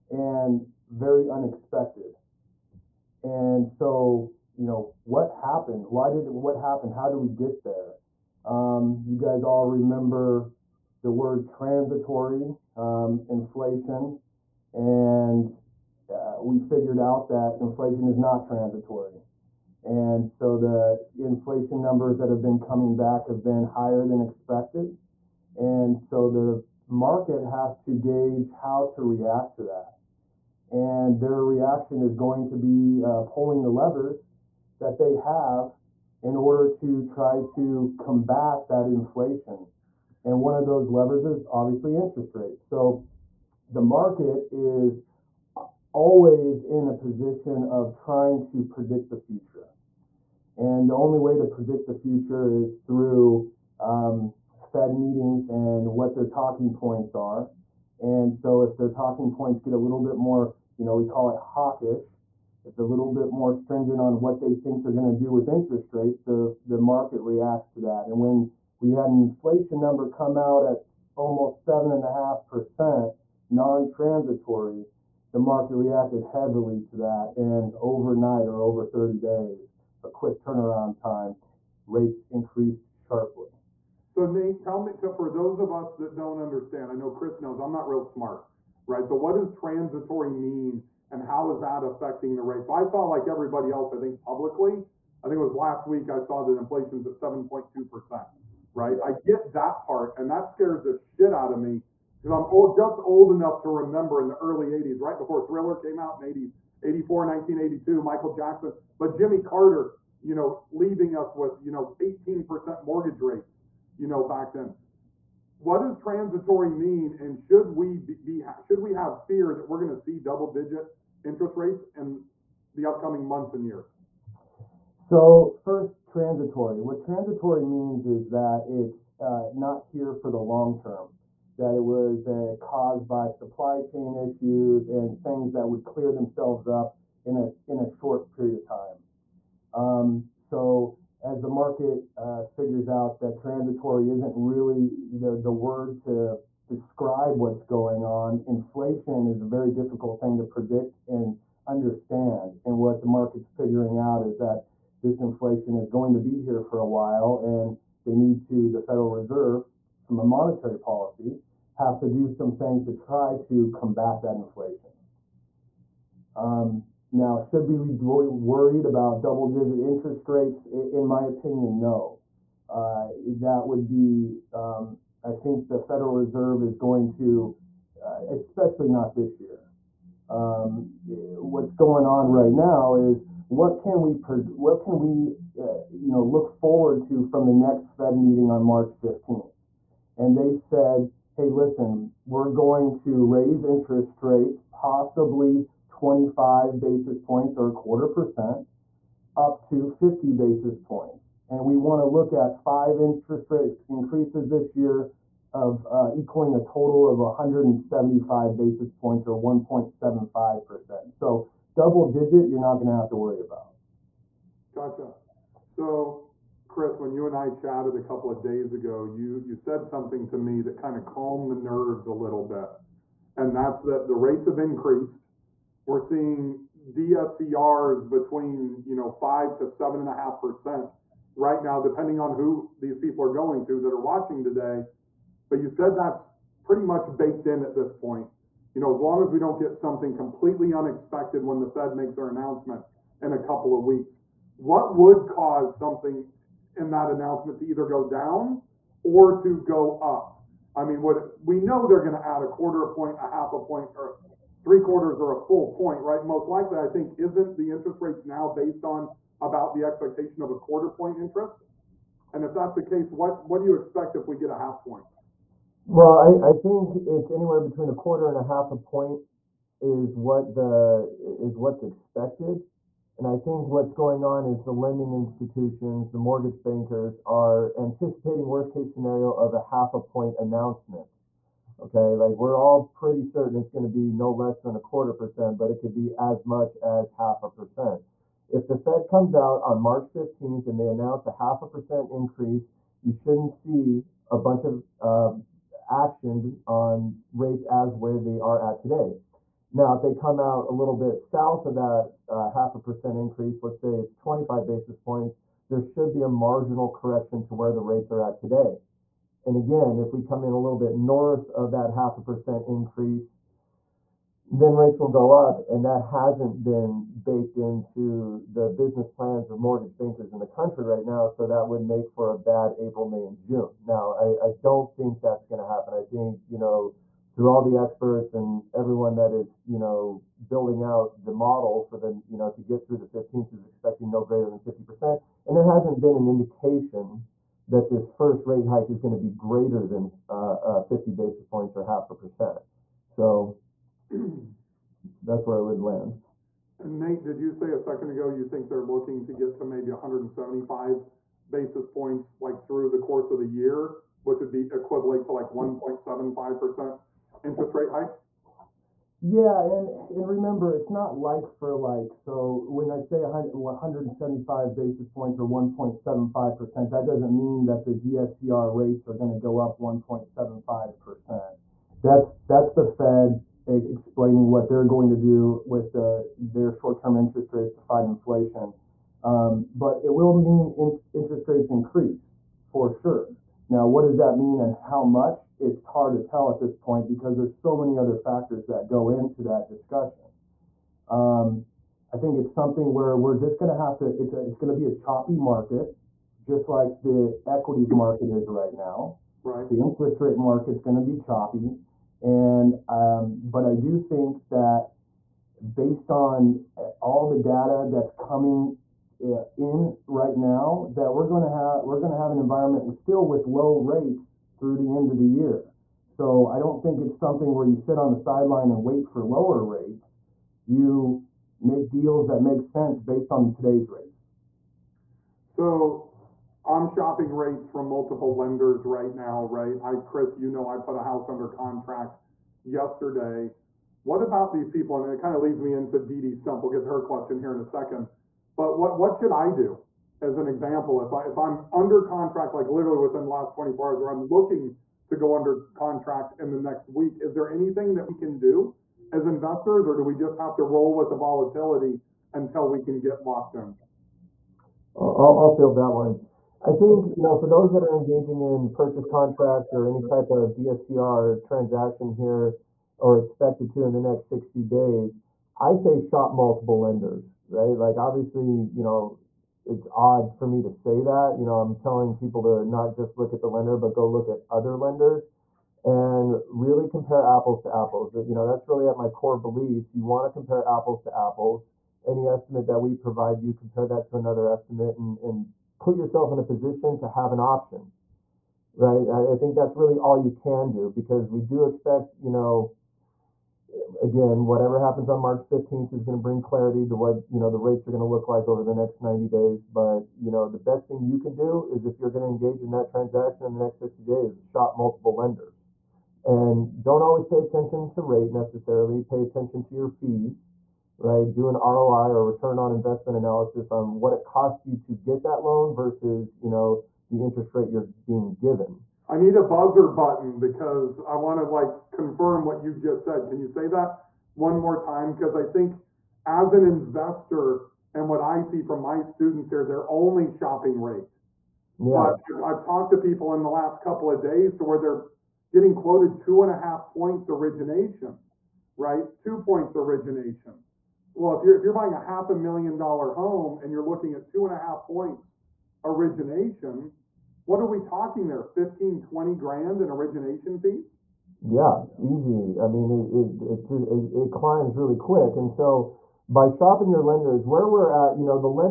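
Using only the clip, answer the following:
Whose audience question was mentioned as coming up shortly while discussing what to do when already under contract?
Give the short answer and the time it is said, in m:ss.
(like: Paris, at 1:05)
Dee Dee Stump, at 7:16.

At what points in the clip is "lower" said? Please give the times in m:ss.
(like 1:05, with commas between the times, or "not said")
6:59.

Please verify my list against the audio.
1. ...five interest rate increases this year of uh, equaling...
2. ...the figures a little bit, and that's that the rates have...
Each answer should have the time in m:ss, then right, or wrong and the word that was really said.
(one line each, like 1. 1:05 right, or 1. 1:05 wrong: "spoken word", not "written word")
1. 3:22 right
2. 3:41 wrong: "nerves", not "figures".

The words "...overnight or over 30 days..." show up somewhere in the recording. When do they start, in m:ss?
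1:17.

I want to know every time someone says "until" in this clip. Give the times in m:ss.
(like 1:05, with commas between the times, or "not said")
7:32.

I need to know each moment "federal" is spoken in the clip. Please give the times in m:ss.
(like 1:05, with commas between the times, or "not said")
2:38, 2:55.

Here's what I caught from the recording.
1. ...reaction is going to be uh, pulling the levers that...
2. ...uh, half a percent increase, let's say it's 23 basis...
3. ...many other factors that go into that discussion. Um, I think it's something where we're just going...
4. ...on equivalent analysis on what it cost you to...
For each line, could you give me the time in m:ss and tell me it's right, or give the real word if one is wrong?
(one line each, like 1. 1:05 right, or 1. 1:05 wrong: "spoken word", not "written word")
1. 0:31 right
2. 5:02 wrong: "25", not "23"
3. 6:27 right
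4. 8:32 wrong: "investment", not "equivalent".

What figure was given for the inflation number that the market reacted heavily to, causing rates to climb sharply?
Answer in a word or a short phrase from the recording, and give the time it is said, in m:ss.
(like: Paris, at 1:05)
7.5%, at 1:11.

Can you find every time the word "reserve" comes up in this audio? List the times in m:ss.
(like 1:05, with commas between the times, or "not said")
2:39, 2:56.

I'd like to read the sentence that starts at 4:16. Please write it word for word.
Most likely, I think, isn't the interest rates now based on about the expectation of a quarter point interest?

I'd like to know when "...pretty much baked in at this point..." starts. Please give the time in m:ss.
3:56.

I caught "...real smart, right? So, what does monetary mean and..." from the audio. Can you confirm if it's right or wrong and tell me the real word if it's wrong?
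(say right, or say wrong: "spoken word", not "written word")
wrong: "transitory", not "monetary".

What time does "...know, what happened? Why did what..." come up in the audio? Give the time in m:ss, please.
0:04.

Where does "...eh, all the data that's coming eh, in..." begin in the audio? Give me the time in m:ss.
6:46.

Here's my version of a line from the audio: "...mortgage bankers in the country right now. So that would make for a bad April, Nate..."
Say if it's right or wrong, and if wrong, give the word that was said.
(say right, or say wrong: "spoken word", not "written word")
wrong: "May", not "Nate".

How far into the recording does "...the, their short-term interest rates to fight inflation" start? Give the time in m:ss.
6:15.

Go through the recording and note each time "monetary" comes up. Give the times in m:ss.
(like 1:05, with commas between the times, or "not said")
2:40.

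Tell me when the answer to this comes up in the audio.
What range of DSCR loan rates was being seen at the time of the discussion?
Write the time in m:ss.
3:49.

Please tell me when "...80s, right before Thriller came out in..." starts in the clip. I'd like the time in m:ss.
1:44.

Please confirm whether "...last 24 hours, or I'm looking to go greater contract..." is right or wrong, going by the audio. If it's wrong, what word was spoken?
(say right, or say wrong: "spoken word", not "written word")
wrong: "under", not "greater".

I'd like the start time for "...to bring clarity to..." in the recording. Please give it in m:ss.
8:16.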